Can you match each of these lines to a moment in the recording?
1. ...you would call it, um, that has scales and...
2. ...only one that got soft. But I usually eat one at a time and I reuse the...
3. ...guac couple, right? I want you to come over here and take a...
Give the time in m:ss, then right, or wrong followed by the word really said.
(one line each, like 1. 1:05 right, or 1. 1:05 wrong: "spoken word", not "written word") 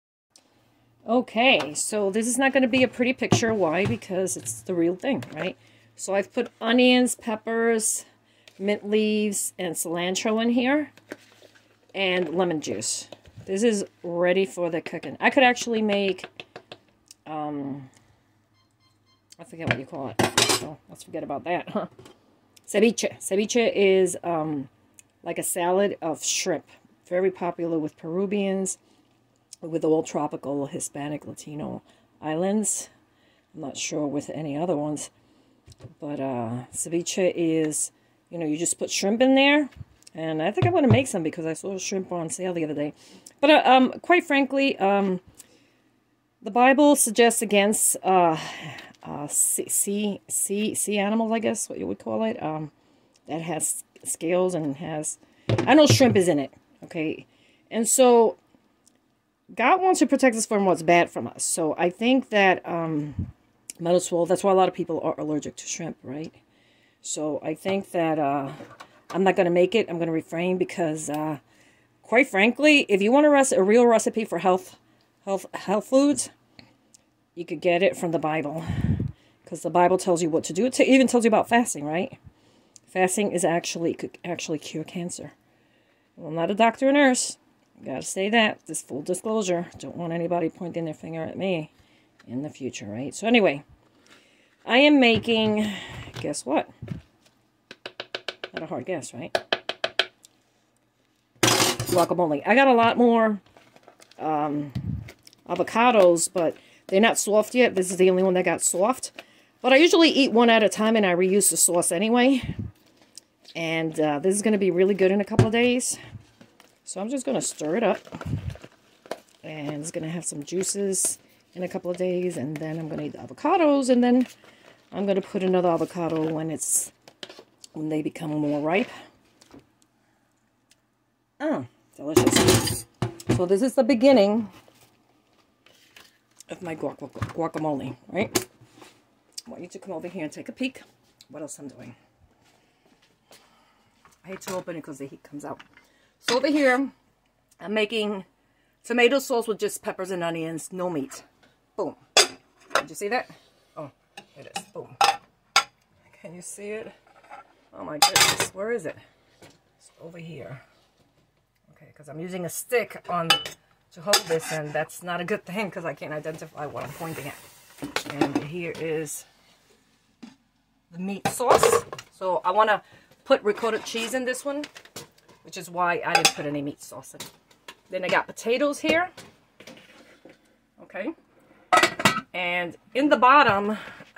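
1. 0:51 right
2. 1:48 right
3. 2:16 wrong: "guacamole", not "couple".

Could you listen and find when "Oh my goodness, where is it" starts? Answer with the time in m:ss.
2:37.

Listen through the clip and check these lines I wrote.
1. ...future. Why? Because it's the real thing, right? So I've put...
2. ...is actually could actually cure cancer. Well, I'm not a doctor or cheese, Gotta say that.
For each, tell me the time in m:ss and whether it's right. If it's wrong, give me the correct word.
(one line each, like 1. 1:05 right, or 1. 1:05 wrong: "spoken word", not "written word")
1. 0:03 wrong: "picture", not "future"
2. 1:23 wrong: "nurse", not "cheese".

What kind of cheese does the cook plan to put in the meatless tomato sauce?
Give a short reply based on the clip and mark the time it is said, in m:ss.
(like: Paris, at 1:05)
ricotta cheese, at 2:53.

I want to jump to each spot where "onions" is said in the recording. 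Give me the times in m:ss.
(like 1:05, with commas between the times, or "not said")
0:06, 2:30.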